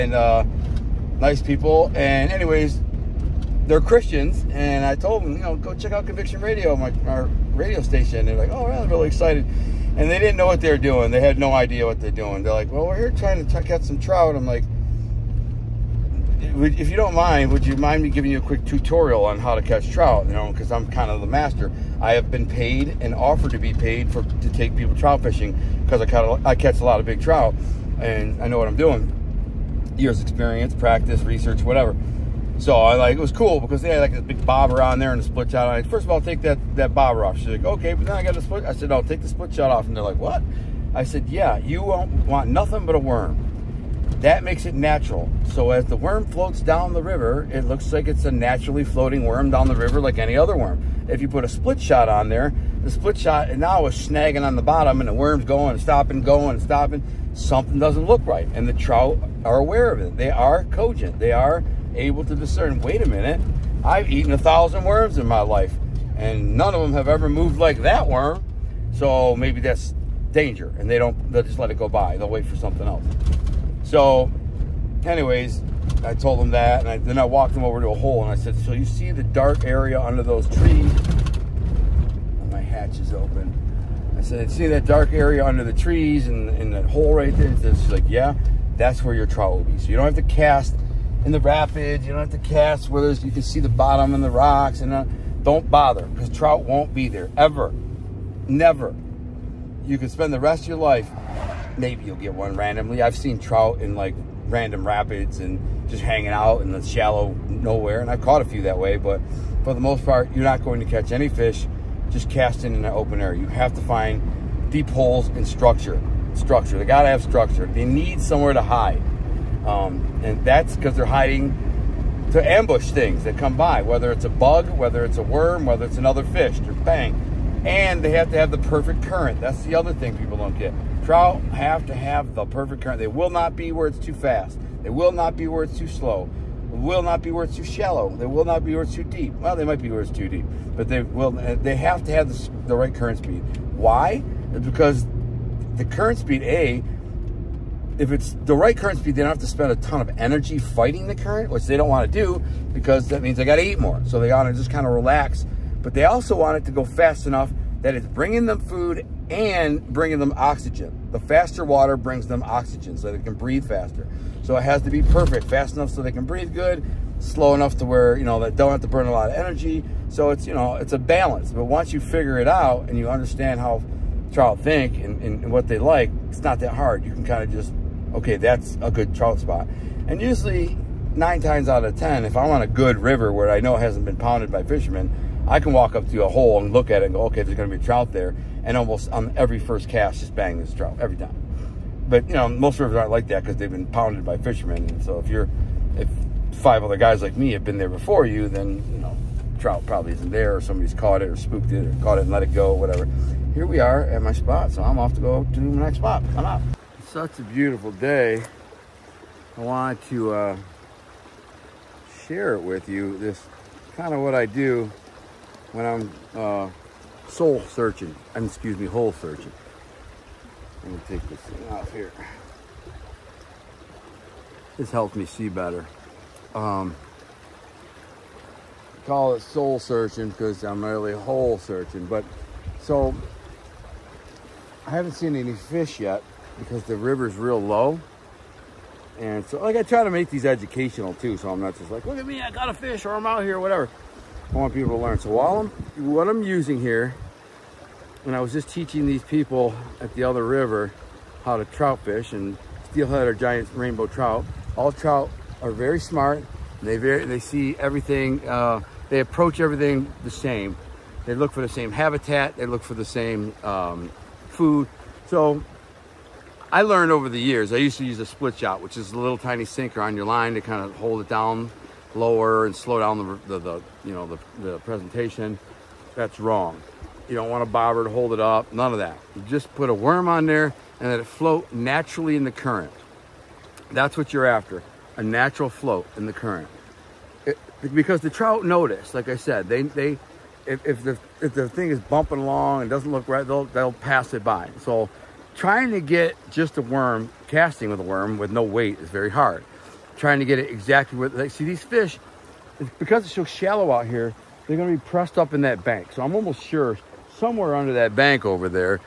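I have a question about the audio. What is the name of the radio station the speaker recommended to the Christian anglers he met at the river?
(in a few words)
Conviction Radio.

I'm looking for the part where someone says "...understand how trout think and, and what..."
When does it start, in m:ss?
2:53.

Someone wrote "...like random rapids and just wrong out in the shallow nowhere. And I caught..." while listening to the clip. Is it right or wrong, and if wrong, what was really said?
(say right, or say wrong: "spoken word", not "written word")
wrong: "hanging", not "wrong".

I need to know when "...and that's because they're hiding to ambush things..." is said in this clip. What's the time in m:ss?
2:00.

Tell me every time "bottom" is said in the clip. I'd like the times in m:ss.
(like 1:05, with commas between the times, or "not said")
0:54, 1:33.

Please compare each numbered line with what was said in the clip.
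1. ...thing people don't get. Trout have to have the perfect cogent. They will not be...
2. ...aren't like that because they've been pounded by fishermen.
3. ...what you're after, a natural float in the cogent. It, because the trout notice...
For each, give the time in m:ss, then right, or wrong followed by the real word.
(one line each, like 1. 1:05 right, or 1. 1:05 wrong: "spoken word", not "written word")
1. 2:09 wrong: "current", not "cogent"
2. 3:12 right
3. 4:44 wrong: "current", not "cogent".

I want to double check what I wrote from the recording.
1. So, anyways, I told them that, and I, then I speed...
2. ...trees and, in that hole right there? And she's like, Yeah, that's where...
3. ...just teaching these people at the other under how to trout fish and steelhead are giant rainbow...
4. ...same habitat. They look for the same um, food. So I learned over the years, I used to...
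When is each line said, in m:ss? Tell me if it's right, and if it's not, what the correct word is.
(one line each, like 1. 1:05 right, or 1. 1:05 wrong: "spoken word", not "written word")
1. 1:13 wrong: "walked", not "speed"
2. 1:25 right
3. 4:08 wrong: "river", not "under"
4. 4:21 right.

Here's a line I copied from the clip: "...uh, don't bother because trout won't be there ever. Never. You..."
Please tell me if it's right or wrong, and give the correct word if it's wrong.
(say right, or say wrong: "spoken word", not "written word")
right.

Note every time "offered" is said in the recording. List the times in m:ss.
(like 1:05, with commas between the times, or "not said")
0:23.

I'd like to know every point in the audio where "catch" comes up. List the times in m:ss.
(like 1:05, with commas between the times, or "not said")
0:19, 0:26, 1:50.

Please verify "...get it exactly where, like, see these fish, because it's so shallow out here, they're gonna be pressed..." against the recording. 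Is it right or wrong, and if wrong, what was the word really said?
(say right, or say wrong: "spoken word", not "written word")
right.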